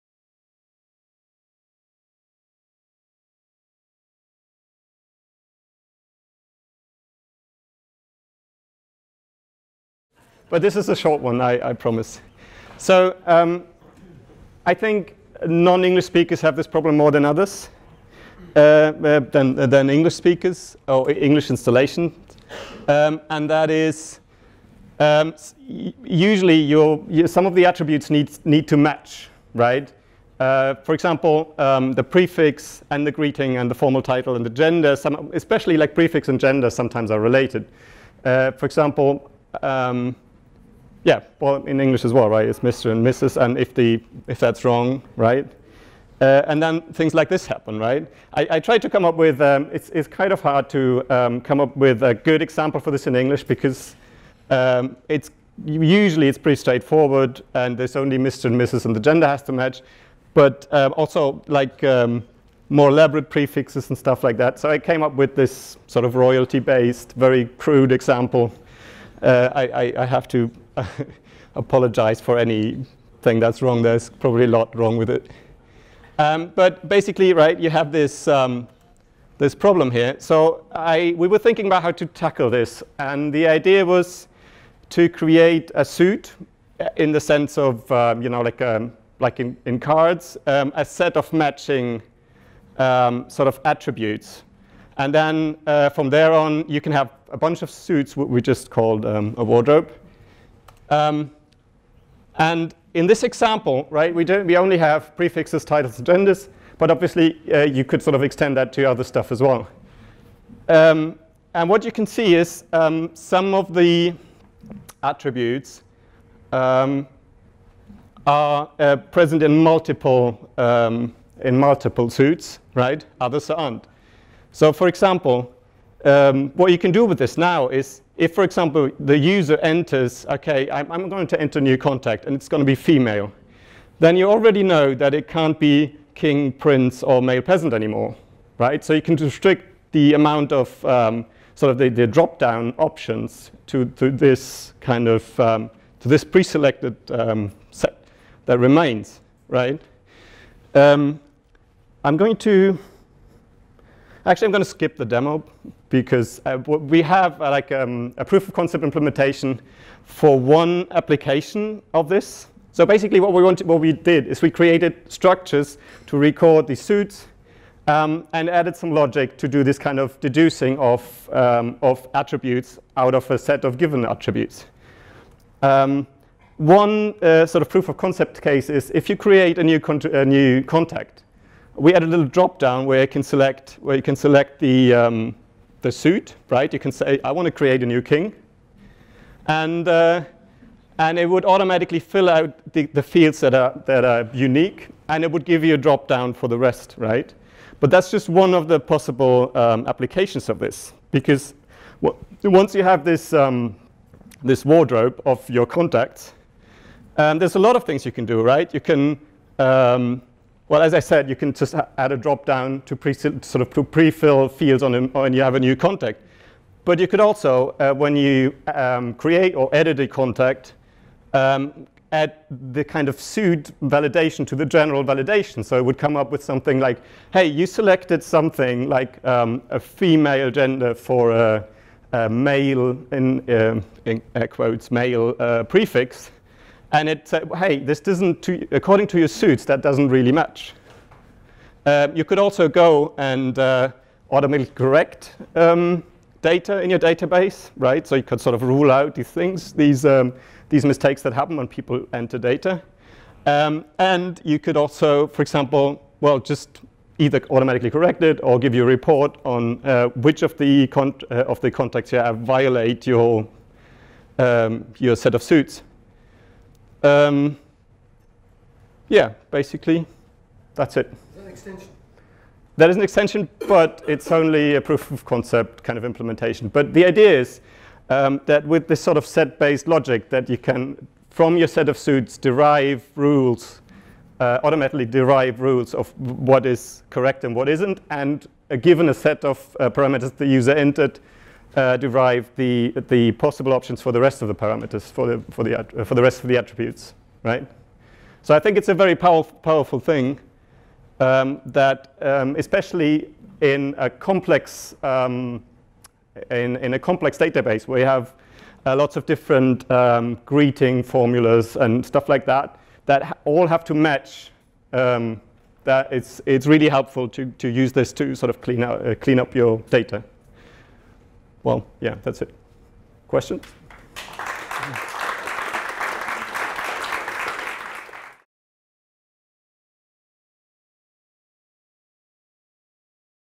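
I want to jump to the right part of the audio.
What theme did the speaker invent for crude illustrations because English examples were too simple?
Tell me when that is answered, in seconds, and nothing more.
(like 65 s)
66 s.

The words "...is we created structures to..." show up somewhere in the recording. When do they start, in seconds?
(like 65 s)
164 s.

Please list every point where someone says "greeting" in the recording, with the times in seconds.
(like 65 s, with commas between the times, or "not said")
33 s, 310 s.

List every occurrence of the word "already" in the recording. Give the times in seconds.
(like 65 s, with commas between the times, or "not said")
134 s.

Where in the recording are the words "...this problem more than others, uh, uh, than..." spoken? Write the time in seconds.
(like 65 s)
16 s.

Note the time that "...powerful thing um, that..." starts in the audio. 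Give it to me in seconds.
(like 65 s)
299 s.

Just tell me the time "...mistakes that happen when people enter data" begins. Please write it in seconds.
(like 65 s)
250 s.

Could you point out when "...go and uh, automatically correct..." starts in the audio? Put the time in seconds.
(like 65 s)
242 s.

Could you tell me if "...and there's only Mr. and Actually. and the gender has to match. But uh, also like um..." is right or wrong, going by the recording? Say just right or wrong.
wrong.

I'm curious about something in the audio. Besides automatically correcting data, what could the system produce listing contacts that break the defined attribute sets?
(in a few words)
a report.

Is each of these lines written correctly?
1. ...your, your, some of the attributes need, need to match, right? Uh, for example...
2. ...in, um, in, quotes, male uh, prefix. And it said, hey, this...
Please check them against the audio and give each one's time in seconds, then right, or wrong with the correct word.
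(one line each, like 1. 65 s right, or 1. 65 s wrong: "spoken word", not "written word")
1. 26 s right
2. 233 s right.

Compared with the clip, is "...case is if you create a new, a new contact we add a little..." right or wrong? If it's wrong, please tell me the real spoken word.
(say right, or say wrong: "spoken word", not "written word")
right.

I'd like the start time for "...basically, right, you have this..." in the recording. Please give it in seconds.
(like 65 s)
76 s.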